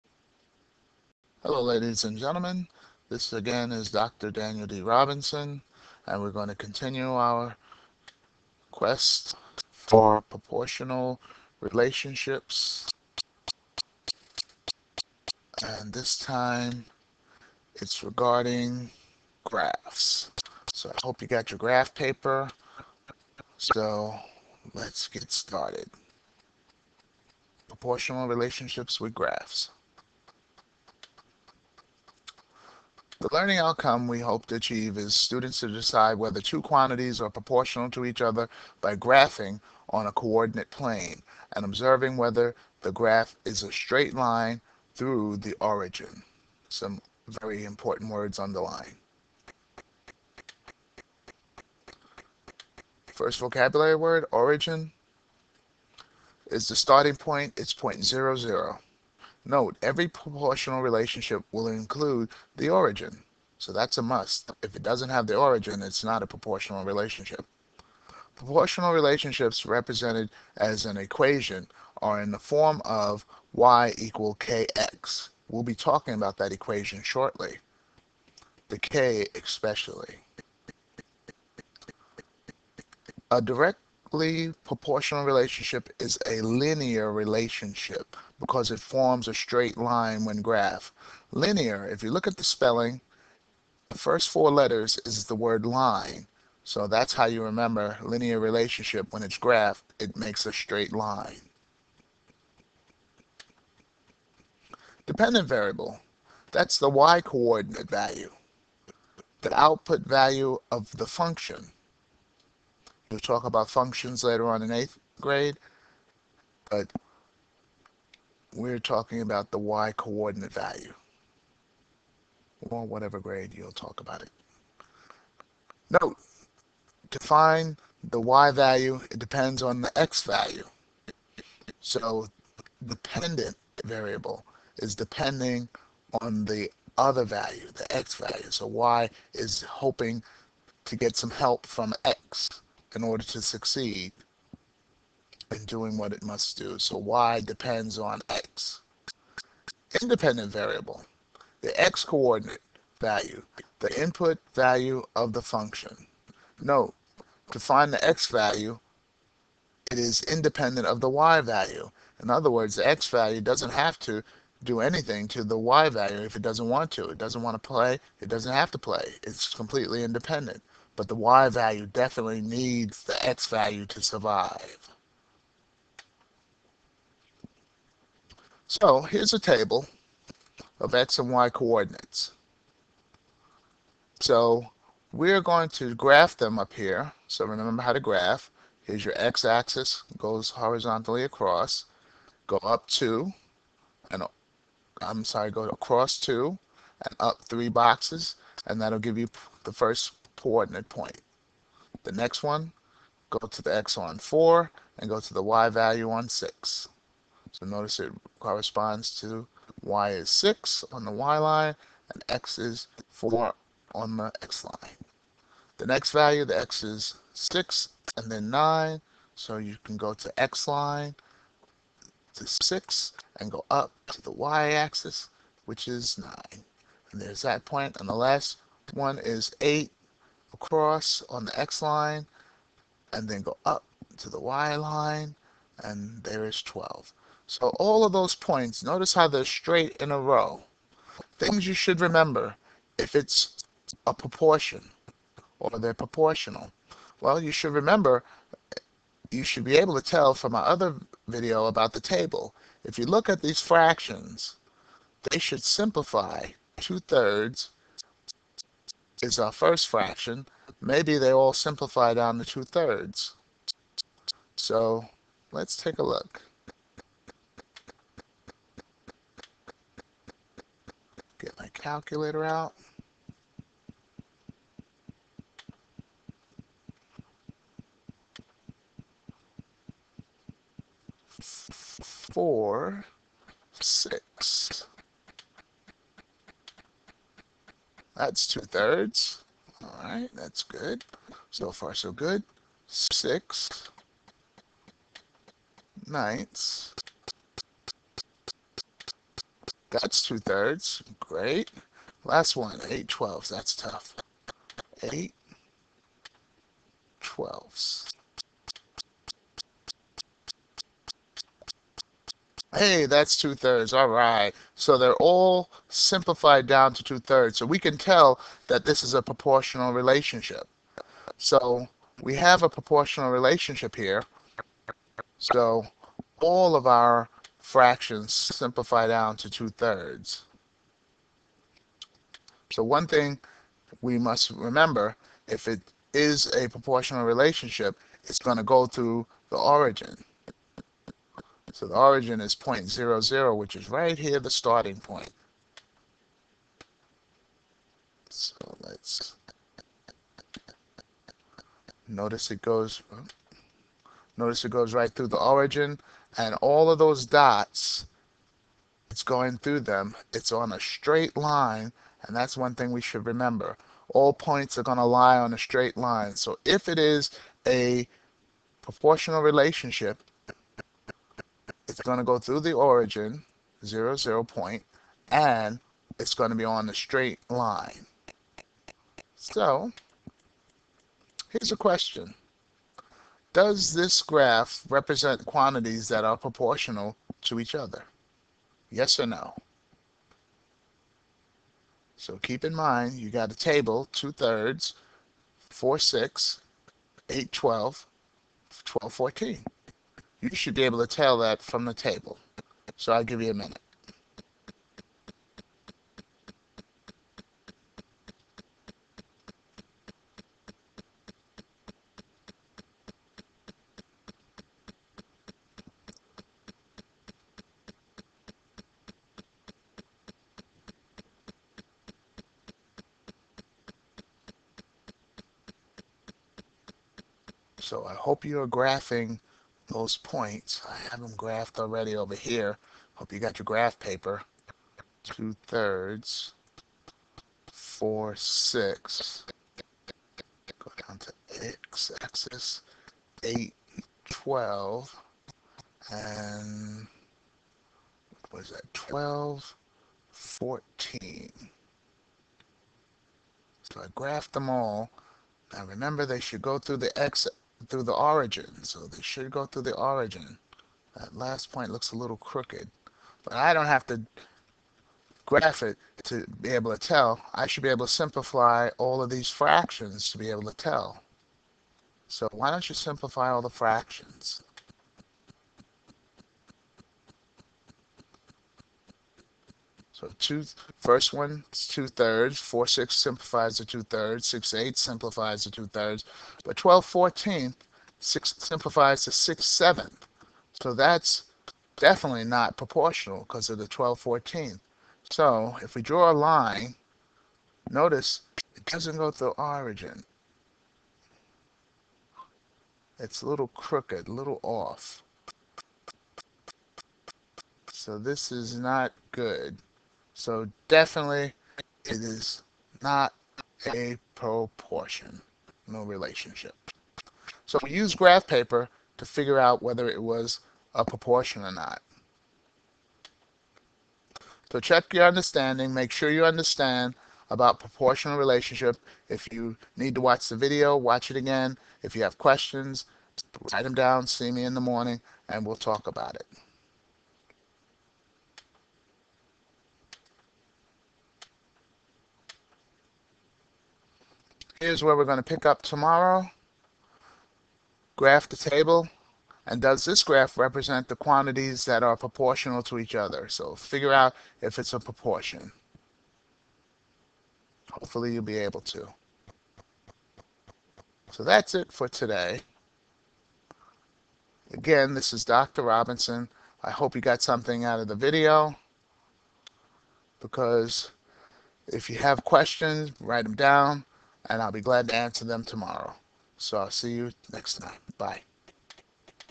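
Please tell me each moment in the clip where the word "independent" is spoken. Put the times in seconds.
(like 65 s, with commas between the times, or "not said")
150 s, 160 s, 170 s.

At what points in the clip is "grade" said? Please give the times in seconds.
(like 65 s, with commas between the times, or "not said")
115 s, 123 s.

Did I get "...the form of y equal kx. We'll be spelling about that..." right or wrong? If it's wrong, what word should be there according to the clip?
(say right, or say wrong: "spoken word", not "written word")
wrong: "talking", not "spelling".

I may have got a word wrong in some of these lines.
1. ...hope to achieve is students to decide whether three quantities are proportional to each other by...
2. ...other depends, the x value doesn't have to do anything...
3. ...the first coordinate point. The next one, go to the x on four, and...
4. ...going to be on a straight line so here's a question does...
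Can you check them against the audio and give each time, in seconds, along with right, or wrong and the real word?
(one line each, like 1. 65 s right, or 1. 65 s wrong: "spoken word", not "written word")
1. 34 s wrong: "two", not "three"
2. 162 s wrong: "words", not "depends"
3. 199 s right
4. 376 s right.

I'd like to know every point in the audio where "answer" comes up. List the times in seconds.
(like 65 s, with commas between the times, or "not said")
575 s.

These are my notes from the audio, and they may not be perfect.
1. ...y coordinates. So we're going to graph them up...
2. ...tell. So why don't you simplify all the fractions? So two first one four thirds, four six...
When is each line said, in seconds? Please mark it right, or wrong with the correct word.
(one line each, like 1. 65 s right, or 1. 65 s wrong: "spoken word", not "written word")
1. 181 s right
2. 470 s wrong: "two", not "four".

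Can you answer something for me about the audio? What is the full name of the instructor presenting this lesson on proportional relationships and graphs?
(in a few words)
Daniel D. Robinson.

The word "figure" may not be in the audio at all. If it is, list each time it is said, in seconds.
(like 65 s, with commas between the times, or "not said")
519 s, 553 s.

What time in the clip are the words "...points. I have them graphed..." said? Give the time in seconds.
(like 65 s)
430 s.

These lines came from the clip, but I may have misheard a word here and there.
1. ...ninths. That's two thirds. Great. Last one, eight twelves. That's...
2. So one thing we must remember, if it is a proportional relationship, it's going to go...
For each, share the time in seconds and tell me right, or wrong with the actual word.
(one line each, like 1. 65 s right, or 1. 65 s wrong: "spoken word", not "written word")
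1. 296 s right
2. 332 s right.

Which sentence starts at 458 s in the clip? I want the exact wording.
So they should go through the origin.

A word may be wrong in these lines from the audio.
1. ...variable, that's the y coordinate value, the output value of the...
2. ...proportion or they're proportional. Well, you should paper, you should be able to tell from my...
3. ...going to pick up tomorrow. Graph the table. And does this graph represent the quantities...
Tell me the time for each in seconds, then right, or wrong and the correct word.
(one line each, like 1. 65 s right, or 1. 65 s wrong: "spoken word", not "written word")
1. 105 s right
2. 244 s wrong: "remember", not "paper"
3. 545 s right.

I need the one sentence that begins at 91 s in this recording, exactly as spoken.
Linear, if you look at the spelling, the first four letters is the word line.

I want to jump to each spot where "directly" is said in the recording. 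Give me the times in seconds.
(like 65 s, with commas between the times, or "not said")
83 s.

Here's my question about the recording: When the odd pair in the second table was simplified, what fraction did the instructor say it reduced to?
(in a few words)
6/7.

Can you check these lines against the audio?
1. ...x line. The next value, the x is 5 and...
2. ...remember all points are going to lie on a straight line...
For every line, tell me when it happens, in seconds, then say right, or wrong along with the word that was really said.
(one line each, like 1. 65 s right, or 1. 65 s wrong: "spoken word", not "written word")
1. 214 s wrong: "6", not "5"
2. 363 s right.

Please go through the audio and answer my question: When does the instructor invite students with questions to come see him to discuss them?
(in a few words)
in the morning.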